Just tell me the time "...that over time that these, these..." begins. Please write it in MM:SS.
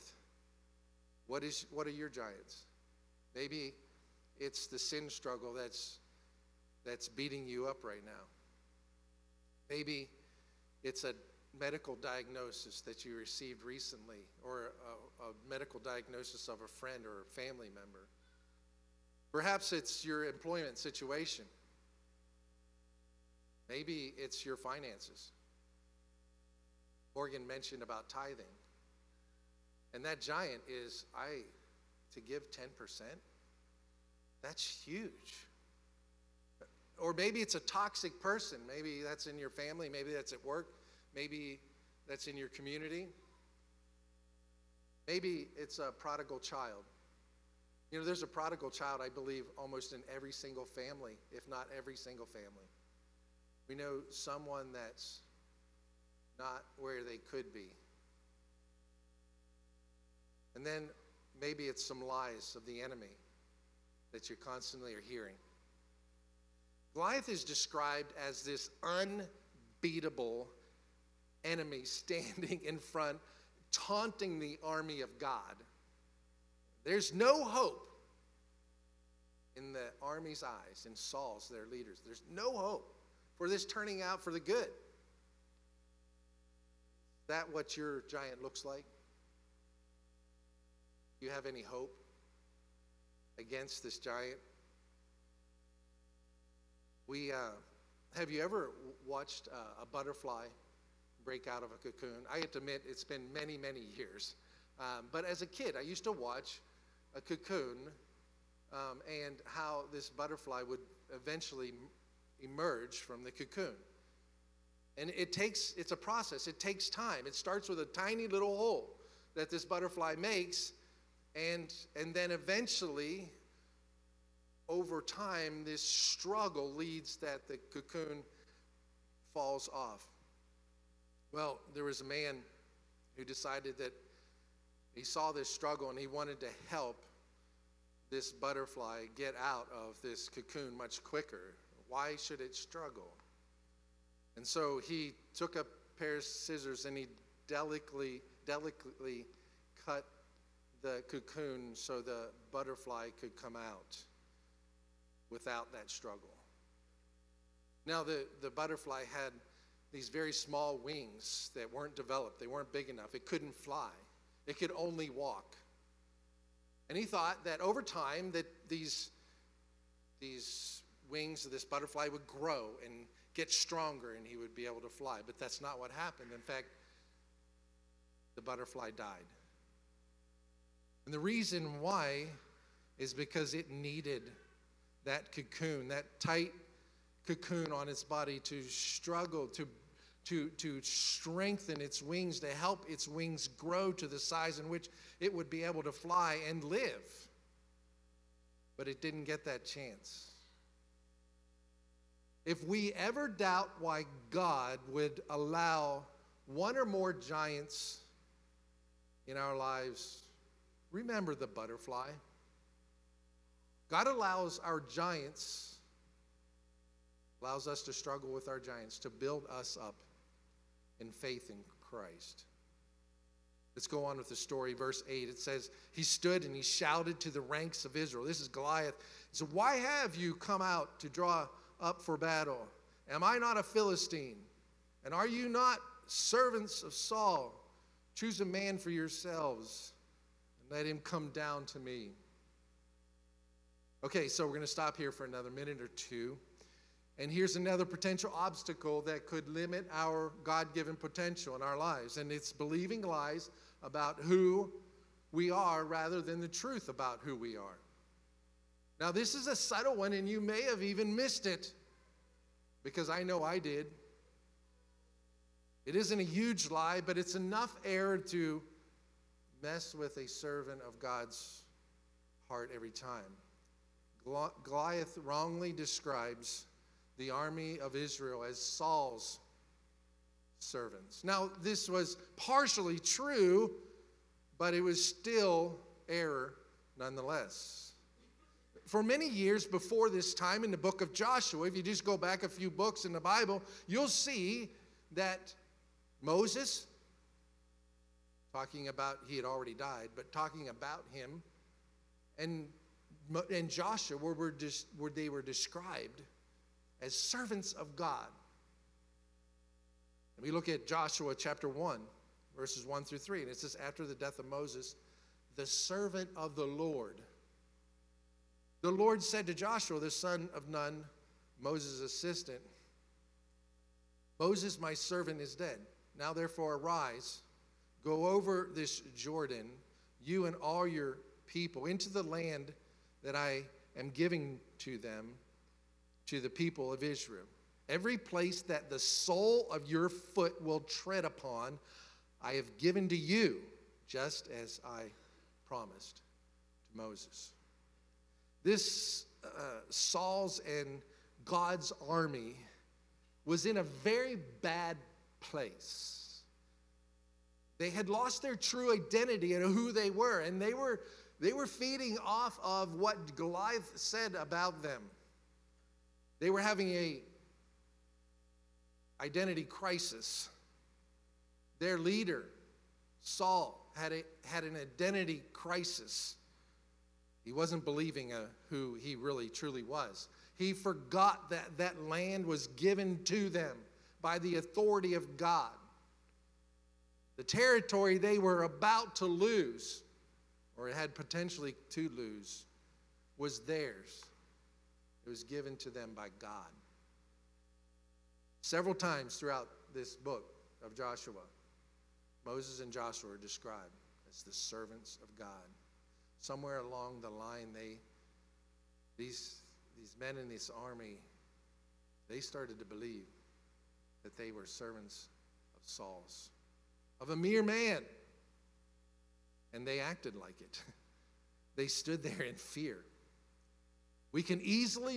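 02:47.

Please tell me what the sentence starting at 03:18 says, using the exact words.
But it didn't get that chance.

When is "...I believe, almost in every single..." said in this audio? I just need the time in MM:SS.
00:49.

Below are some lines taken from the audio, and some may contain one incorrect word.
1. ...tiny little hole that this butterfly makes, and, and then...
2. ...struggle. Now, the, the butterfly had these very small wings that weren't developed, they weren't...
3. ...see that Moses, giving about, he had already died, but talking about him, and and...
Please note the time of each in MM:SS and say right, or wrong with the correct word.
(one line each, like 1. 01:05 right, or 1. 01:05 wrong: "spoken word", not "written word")
1. 01:57 right
2. 02:35 right
3. 04:54 wrong: "talking", not "giving".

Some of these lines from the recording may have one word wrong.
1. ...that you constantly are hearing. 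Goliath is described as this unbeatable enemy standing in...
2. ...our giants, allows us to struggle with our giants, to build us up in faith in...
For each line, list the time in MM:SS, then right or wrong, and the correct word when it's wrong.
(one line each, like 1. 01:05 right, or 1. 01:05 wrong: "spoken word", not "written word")
1. 01:04 right
2. 03:34 right.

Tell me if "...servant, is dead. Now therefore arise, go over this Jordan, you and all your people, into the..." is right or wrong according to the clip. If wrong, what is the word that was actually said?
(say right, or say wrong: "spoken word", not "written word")
right.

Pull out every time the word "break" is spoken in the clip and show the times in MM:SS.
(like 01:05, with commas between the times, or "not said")
01:41.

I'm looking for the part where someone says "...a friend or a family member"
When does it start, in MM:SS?
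00:16.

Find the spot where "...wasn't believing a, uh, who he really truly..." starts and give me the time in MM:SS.
06:17.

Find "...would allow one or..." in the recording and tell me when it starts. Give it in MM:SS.
03:24.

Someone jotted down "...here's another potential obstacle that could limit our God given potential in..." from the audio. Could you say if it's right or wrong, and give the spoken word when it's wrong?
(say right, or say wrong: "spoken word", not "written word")
right.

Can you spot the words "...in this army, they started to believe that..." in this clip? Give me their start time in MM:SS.
06:50.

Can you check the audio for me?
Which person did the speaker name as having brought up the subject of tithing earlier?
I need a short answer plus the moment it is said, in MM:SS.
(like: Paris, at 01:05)
Morgan, at 00:27.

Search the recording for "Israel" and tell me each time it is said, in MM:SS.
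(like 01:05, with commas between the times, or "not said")
03:47, 04:37, 05:37.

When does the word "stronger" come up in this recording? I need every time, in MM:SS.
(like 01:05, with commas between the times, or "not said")
02:53.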